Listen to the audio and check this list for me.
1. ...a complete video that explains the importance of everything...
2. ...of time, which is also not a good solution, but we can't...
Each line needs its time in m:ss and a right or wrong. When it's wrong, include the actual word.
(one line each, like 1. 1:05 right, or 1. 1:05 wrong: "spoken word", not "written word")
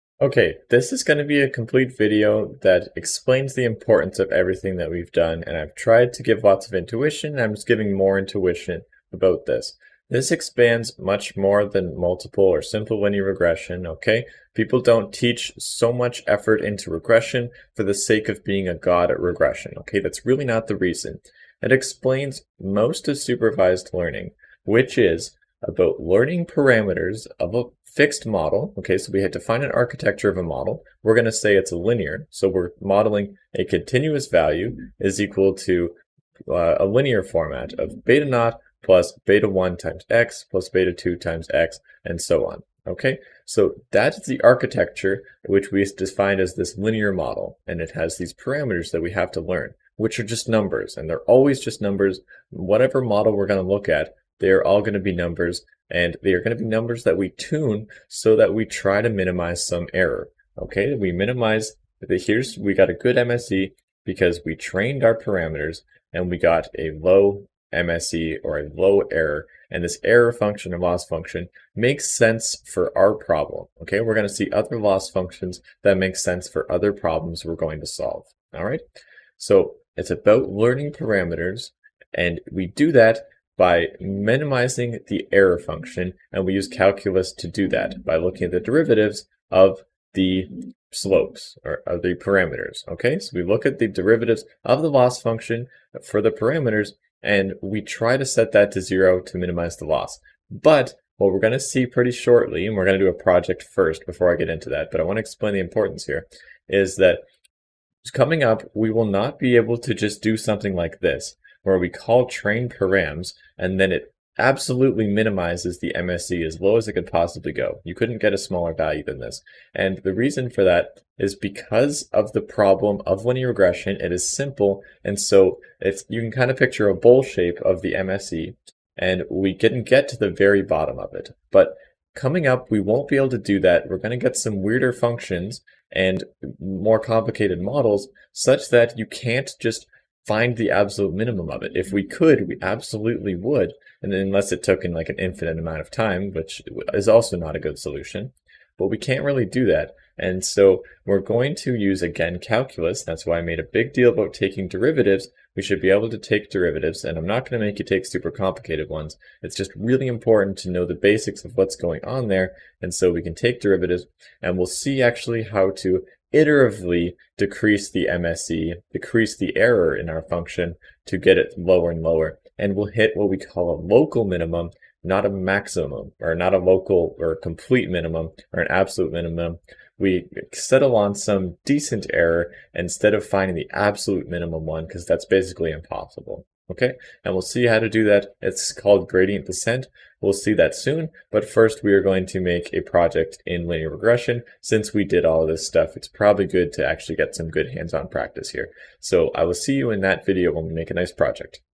1. 0:01 right
2. 2:25 right.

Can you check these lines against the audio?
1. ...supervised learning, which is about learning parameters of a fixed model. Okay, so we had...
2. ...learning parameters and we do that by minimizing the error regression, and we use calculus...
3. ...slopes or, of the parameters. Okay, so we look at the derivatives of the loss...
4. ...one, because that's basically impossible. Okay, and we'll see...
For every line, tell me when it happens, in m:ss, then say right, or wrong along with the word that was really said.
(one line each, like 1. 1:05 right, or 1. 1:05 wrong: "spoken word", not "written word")
1. 0:23 right
2. 1:20 wrong: "function", not "regression"
3. 1:30 right
4. 3:04 right.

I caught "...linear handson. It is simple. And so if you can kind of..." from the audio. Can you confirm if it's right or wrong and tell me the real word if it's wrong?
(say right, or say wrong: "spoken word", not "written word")
wrong: "regression", not "handson".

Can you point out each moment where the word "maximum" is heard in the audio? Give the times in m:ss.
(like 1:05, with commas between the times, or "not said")
2:55.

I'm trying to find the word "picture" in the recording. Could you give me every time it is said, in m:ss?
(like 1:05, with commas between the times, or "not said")
2:06.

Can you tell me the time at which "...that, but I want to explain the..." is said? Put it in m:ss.
1:44.